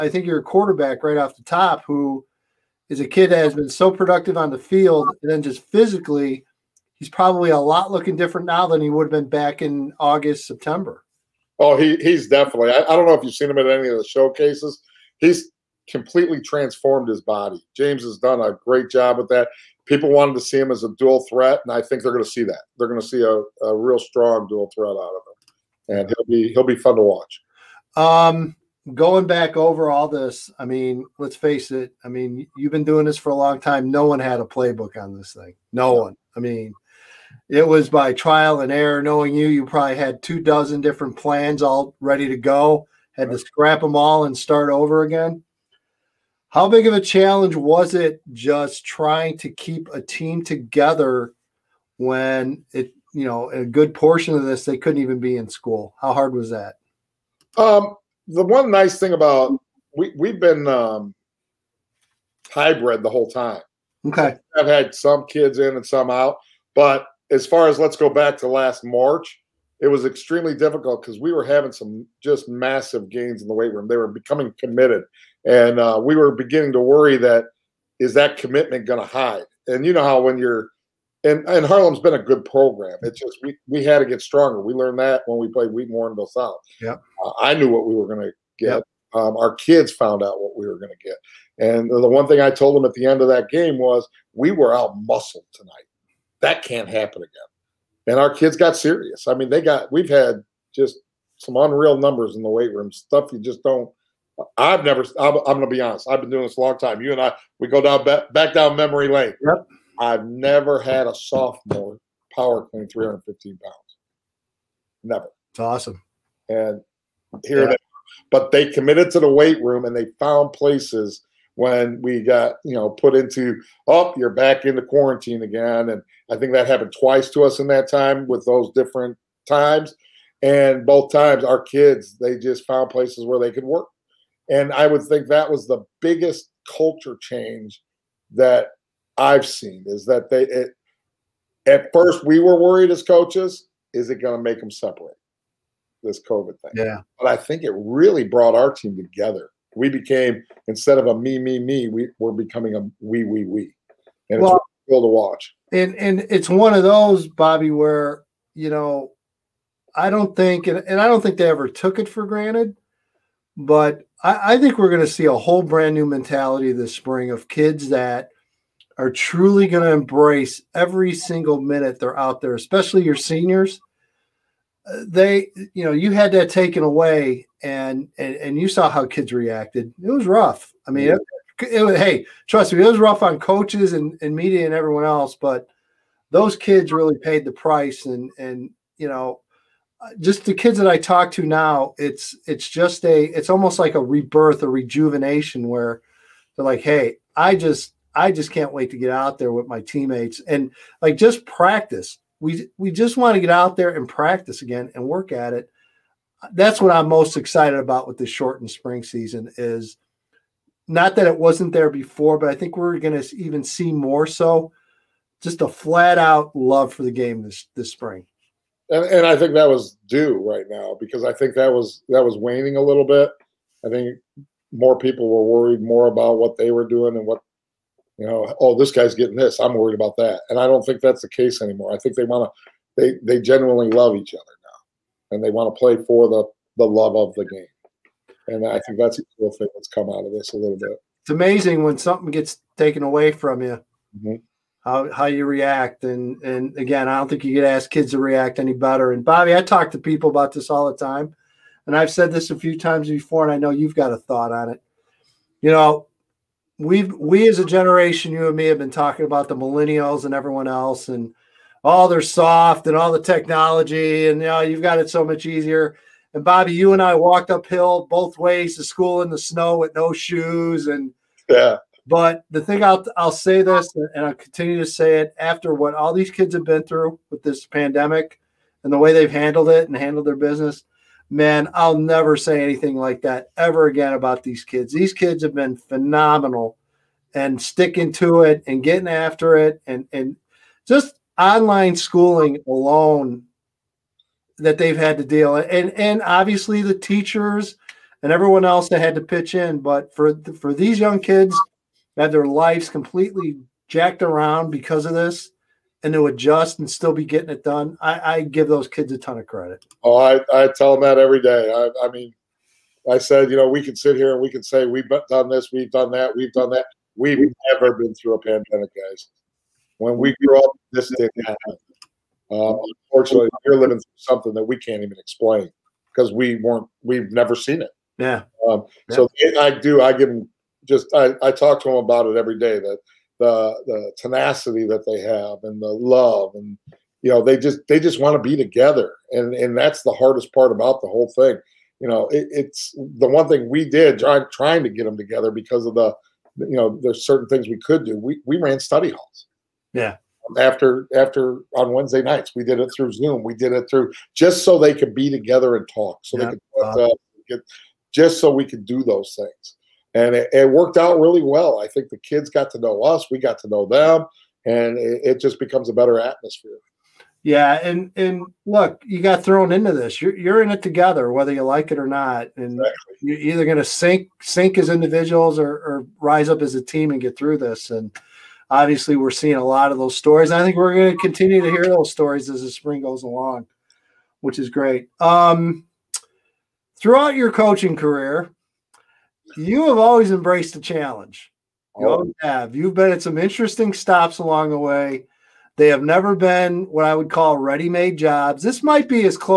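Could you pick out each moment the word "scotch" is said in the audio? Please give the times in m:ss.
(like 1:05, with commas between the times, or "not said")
not said.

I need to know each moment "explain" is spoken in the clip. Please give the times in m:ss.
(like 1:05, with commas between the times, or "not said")
5:25.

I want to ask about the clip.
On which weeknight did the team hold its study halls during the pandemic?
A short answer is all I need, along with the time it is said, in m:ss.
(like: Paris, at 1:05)
Wednesday, at 5:51.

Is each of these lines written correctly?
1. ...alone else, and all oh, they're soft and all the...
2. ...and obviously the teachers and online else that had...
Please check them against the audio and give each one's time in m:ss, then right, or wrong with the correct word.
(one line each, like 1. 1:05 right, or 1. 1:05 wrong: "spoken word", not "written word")
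1. 4:20 wrong: "everyone", not "alone"
2. 4:55 wrong: "everyone", not "online".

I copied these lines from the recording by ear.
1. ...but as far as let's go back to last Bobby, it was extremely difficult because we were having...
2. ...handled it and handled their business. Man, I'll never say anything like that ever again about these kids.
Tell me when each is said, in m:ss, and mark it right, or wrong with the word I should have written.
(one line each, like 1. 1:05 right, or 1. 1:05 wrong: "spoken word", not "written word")
1. 1:06 wrong: "March", not "Bobby"
2. 4:39 right.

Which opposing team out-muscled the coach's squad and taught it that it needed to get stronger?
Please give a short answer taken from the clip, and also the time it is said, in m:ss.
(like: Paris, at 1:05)
Wheaton Warrenville South, at 1:25.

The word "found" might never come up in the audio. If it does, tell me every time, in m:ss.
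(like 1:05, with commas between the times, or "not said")
1:29, 2:00, 2:12.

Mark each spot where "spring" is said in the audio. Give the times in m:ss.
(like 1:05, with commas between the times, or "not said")
2:46, 3:28, 3:37, 6:22.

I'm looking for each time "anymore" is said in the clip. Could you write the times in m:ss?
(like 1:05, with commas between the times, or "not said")
3:51.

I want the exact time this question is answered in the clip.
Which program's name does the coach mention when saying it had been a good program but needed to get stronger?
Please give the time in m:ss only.
1:21.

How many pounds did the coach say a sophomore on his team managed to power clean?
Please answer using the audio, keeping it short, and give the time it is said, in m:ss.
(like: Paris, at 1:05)
315, at 1:52.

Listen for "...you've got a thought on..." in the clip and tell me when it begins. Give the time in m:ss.
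4:13.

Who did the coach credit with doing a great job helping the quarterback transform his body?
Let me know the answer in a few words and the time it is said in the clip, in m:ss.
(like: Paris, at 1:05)
James, at 0:17.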